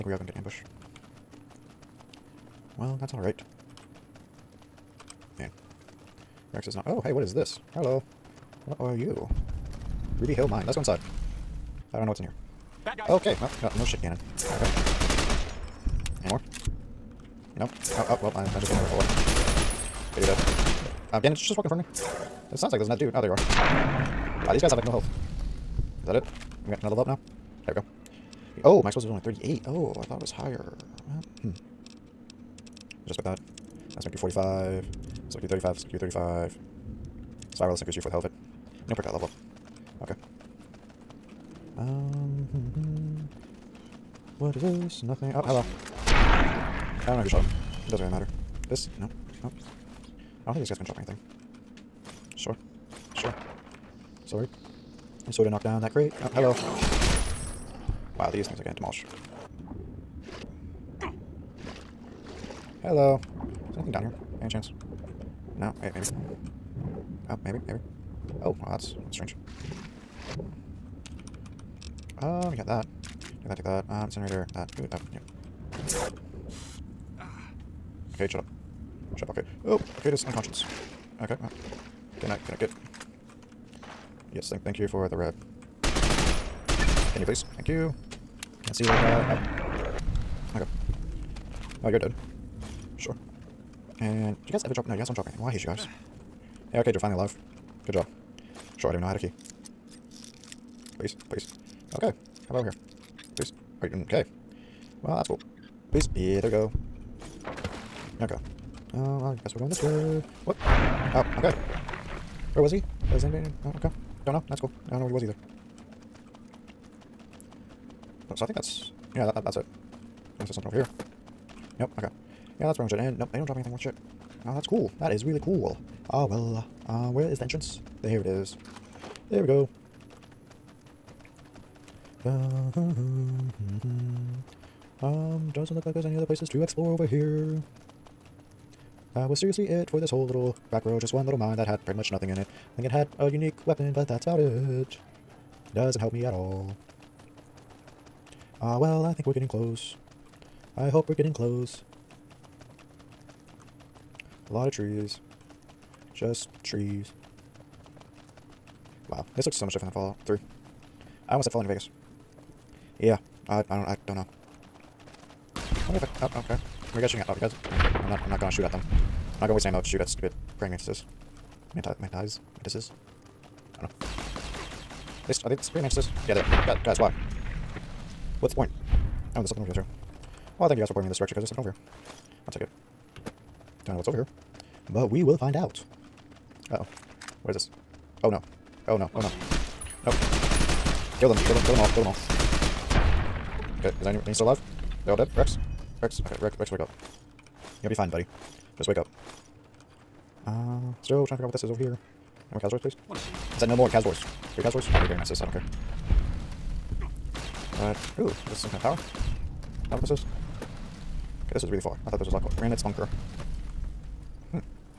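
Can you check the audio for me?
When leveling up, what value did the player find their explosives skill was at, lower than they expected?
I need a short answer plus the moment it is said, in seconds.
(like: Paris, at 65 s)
38, at 29 s.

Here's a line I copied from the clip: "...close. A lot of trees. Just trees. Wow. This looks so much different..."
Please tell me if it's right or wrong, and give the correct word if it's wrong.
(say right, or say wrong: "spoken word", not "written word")
right.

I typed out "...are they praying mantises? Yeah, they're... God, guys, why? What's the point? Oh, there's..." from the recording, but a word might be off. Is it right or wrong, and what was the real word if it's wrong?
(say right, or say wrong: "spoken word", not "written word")
right.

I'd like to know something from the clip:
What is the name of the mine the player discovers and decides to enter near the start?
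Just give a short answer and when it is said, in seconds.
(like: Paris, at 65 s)
Ruby Hill Mine, at 10 s.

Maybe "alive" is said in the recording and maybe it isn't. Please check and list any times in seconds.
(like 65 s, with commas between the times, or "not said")
97 s, 194 s.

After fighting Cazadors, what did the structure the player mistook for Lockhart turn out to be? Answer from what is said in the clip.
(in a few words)
Remnants bunker.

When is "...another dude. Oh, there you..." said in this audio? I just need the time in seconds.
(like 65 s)
22 s.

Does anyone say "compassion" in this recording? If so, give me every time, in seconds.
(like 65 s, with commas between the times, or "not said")
not said.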